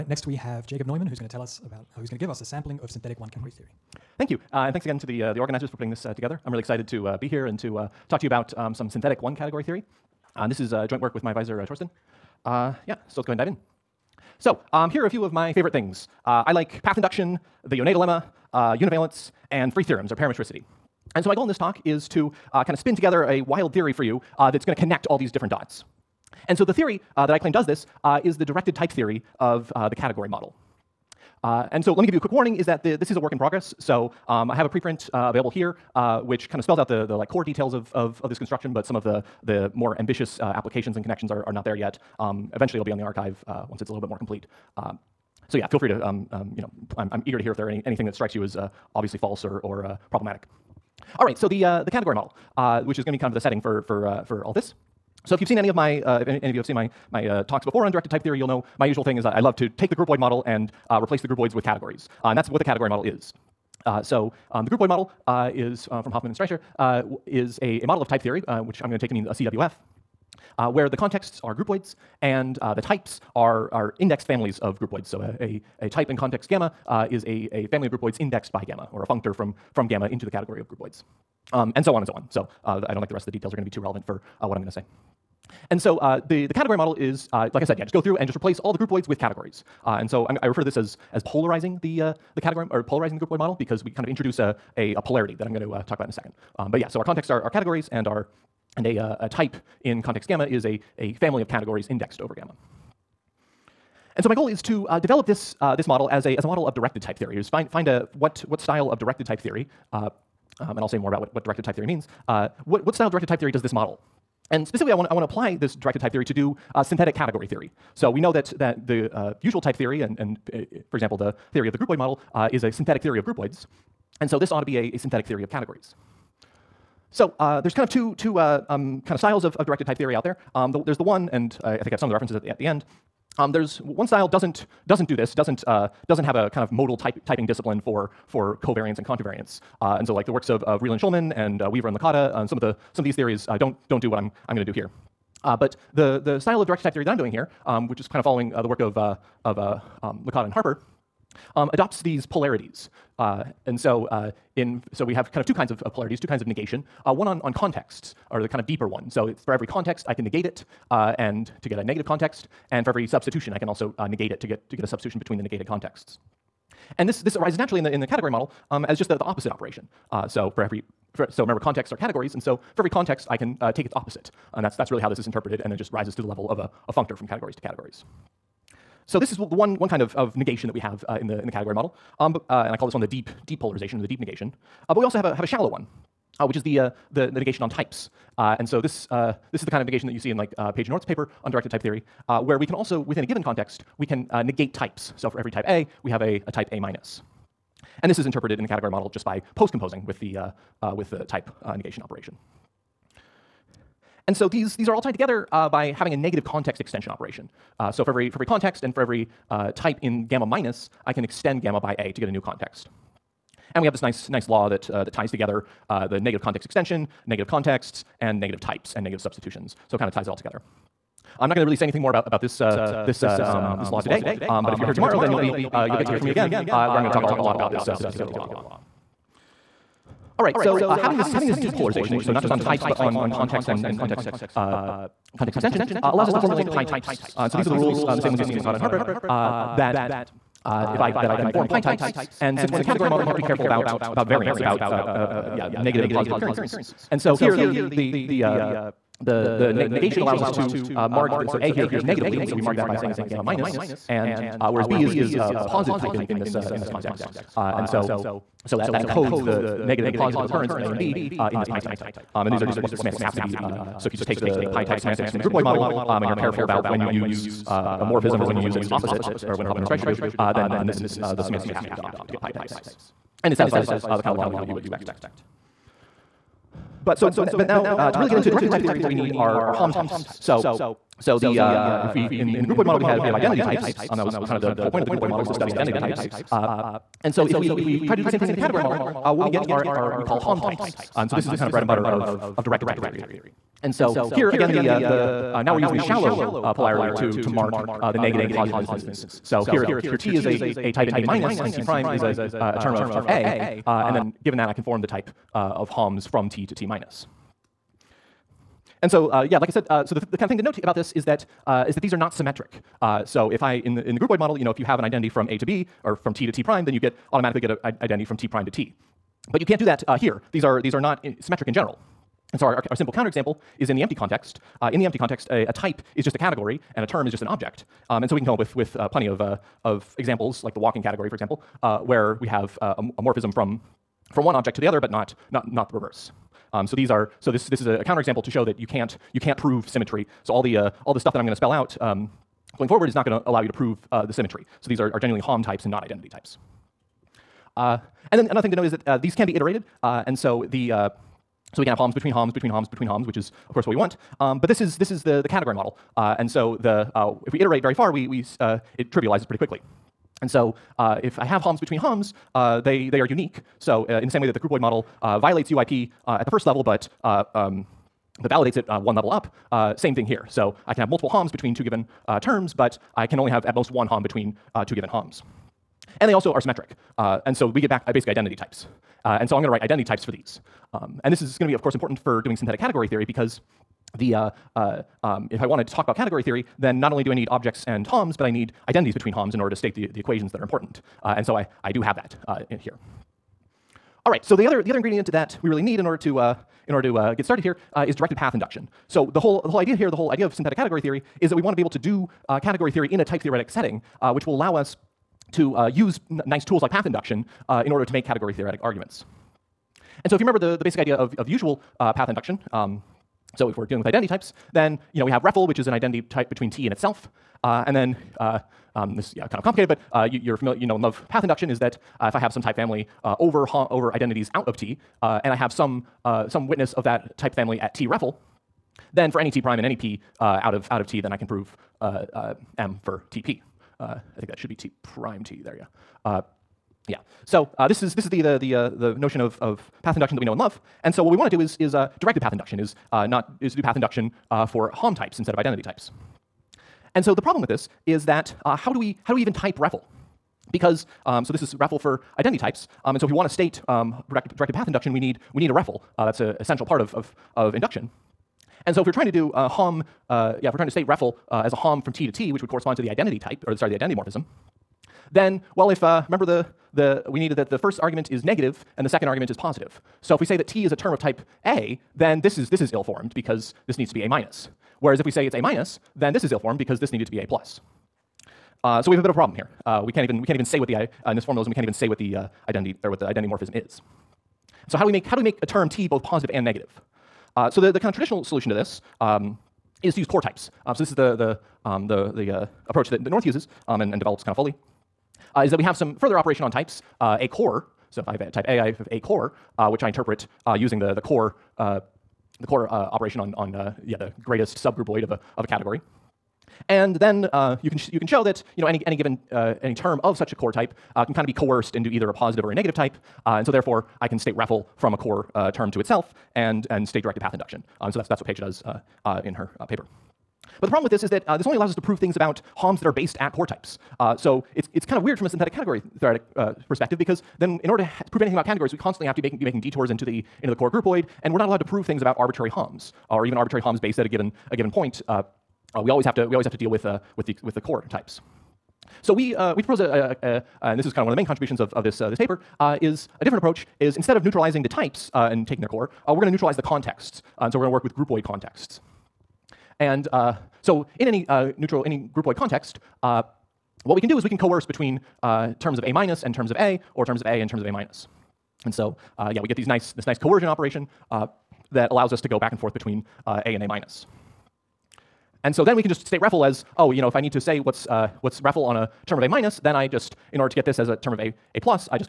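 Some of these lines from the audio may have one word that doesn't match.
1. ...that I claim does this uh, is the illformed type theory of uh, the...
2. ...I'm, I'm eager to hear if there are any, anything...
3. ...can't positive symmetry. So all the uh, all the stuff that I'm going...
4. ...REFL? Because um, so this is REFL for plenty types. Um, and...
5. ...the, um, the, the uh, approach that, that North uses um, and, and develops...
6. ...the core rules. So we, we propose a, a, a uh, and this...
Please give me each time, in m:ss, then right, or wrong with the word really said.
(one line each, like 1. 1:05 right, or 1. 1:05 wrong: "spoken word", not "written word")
1. 0:27 wrong: "directed", not "illformed"
2. 0:46 right
3. 5:39 wrong: "prove", not "positive"
4. 7:29 wrong: "identity", not "plenty"
5. 8:11 right
6. 8:57 wrong: "types", not "rules".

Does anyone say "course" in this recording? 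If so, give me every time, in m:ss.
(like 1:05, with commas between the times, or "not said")
5:53, 6:21.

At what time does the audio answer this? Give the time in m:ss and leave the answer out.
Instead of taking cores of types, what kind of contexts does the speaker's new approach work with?
9:08.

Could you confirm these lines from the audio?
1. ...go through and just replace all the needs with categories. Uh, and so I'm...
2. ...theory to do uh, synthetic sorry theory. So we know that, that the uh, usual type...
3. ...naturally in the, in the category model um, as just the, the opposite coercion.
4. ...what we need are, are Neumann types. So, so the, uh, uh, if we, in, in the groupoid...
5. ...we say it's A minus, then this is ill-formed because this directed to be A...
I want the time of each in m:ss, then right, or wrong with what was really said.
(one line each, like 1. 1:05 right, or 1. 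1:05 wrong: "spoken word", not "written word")
1. 1:27 wrong: "groupoids", not "needs"
2. 1:56 wrong: "category", not "sorry"
3. 2:47 wrong: "operation", not "coercion"
4. 4:38 wrong: "HOM", not "Neumann"
5. 7:55 wrong: "needed", not "directed".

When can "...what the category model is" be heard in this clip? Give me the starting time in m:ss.
1:02.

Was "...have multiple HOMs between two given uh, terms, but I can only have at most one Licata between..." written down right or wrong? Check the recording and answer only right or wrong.
wrong.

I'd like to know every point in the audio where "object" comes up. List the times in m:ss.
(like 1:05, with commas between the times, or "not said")
5:27, 5:34, 6:27.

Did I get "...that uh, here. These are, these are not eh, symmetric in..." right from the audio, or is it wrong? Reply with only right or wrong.
right.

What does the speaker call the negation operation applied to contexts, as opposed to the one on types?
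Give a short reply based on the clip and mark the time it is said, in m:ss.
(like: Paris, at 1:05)
Deep negation, at 3:04.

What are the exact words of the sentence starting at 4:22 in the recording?
Um, and these are just what the semantics have to be.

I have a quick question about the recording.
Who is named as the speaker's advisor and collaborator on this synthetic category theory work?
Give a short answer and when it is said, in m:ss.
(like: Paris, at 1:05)
Thorsten, at 0:11.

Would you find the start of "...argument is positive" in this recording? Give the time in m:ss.
7:49.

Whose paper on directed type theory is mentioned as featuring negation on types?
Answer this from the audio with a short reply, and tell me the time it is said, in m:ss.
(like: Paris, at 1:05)
Paige North, at 3:10.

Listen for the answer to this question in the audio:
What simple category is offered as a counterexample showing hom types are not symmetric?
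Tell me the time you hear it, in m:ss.
5:30.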